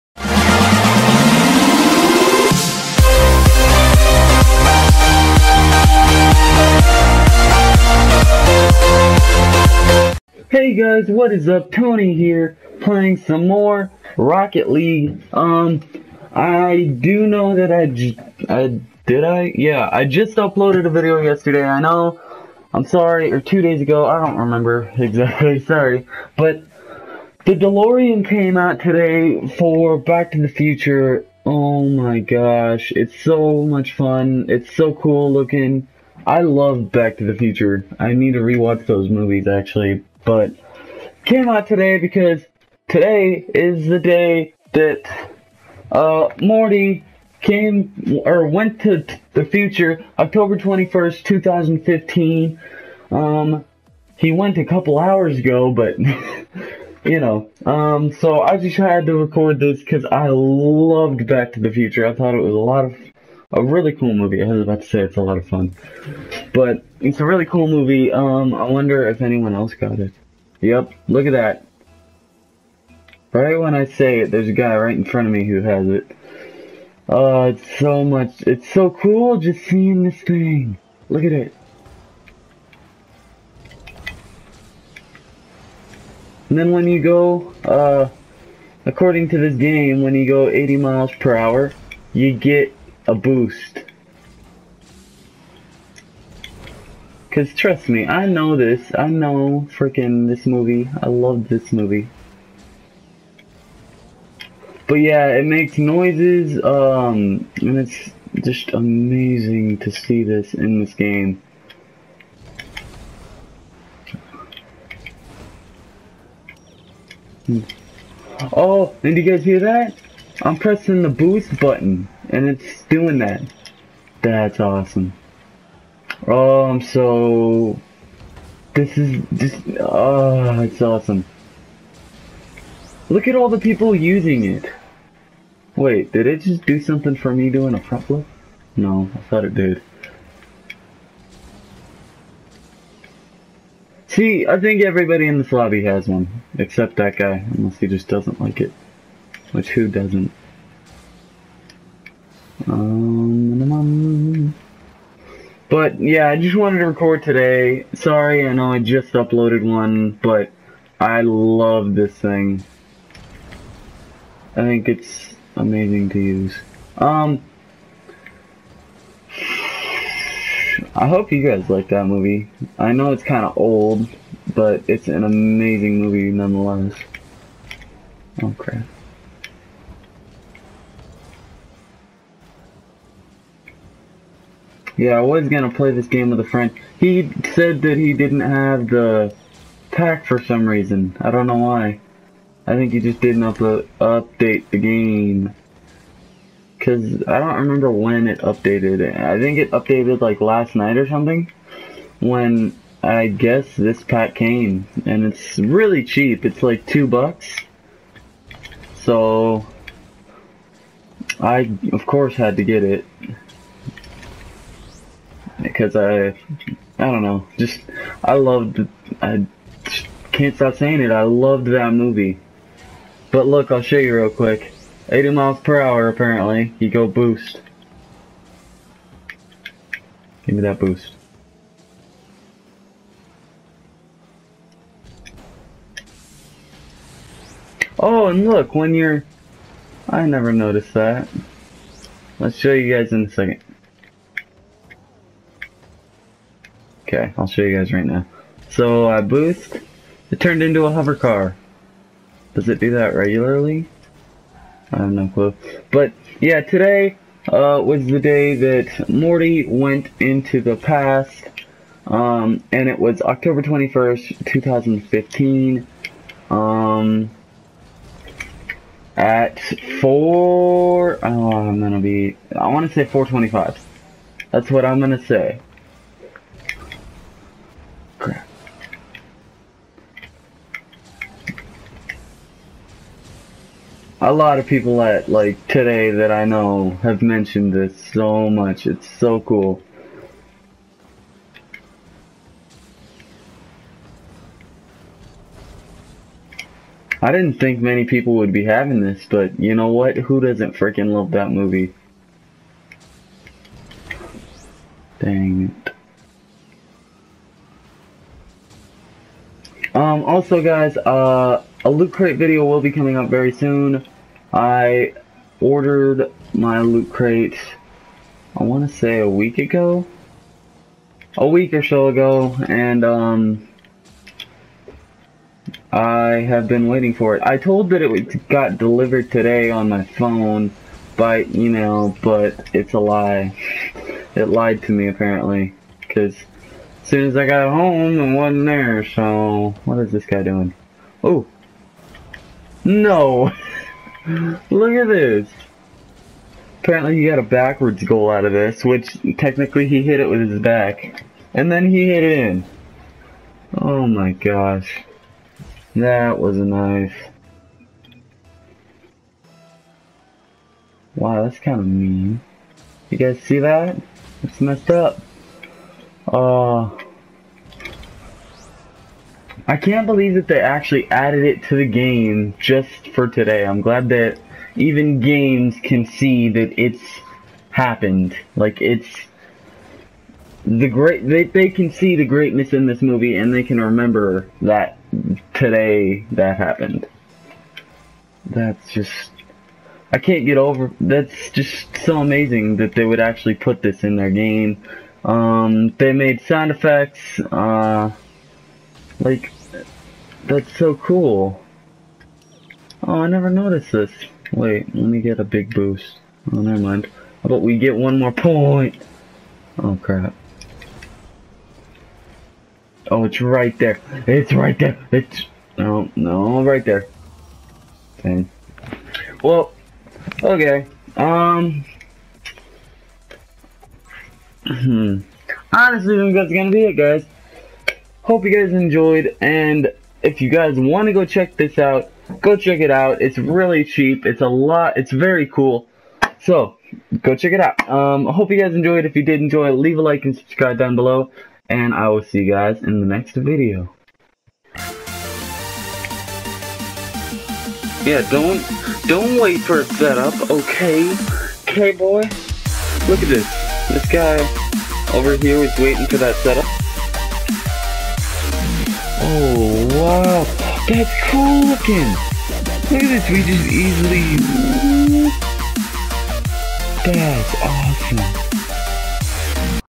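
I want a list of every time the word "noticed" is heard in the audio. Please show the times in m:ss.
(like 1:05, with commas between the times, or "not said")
4:00, 6:43.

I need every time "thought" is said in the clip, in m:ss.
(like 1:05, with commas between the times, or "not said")
1:02, 2:19.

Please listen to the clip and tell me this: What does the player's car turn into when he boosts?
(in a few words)
hover car.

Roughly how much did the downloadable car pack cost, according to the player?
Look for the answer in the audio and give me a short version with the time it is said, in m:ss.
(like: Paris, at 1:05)
2 bucks, at 3:26.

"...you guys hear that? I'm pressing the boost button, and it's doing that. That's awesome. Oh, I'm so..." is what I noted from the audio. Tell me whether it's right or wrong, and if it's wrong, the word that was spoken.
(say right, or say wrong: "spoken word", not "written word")
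right.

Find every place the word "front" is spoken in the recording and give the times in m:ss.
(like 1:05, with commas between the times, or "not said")
1:15, 2:17.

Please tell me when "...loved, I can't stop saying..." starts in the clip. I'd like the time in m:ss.
3:38.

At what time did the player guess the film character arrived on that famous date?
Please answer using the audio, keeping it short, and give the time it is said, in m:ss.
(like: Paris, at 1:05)
4:25, at 4:33.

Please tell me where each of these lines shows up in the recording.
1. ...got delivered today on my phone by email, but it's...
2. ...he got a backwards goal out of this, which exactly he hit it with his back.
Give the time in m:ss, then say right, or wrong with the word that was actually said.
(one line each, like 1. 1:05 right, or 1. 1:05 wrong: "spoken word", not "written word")
1. 5:28 right
2. 5:47 wrong: "technically", not "exactly".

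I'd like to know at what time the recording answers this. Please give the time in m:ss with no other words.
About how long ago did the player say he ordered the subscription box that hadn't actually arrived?
5:19.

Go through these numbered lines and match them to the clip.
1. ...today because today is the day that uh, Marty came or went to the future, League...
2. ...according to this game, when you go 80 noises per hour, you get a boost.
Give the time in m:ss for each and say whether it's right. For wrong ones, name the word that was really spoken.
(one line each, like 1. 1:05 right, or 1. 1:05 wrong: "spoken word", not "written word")
1. 0:41 wrong: "October", not "League"
2. 1:28 wrong: "miles", not "noises".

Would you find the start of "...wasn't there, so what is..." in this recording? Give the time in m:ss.
5:38.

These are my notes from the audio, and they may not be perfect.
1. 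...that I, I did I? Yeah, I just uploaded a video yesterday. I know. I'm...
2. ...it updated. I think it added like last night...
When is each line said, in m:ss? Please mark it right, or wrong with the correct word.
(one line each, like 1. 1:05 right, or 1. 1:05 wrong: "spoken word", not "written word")
1. 0:17 right
2. 3:18 wrong: "updated", not "added".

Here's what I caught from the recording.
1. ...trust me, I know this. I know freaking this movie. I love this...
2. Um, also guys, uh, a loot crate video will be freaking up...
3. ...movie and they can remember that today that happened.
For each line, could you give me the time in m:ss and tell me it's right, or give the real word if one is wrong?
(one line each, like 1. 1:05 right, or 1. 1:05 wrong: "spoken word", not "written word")
1. 1:37 right
2. 5:09 wrong: "coming", not "freaking"
3. 6:23 right.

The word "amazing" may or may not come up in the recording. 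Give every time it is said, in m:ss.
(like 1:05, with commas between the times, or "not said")
1:48, 2:45, 2:55, 6:32.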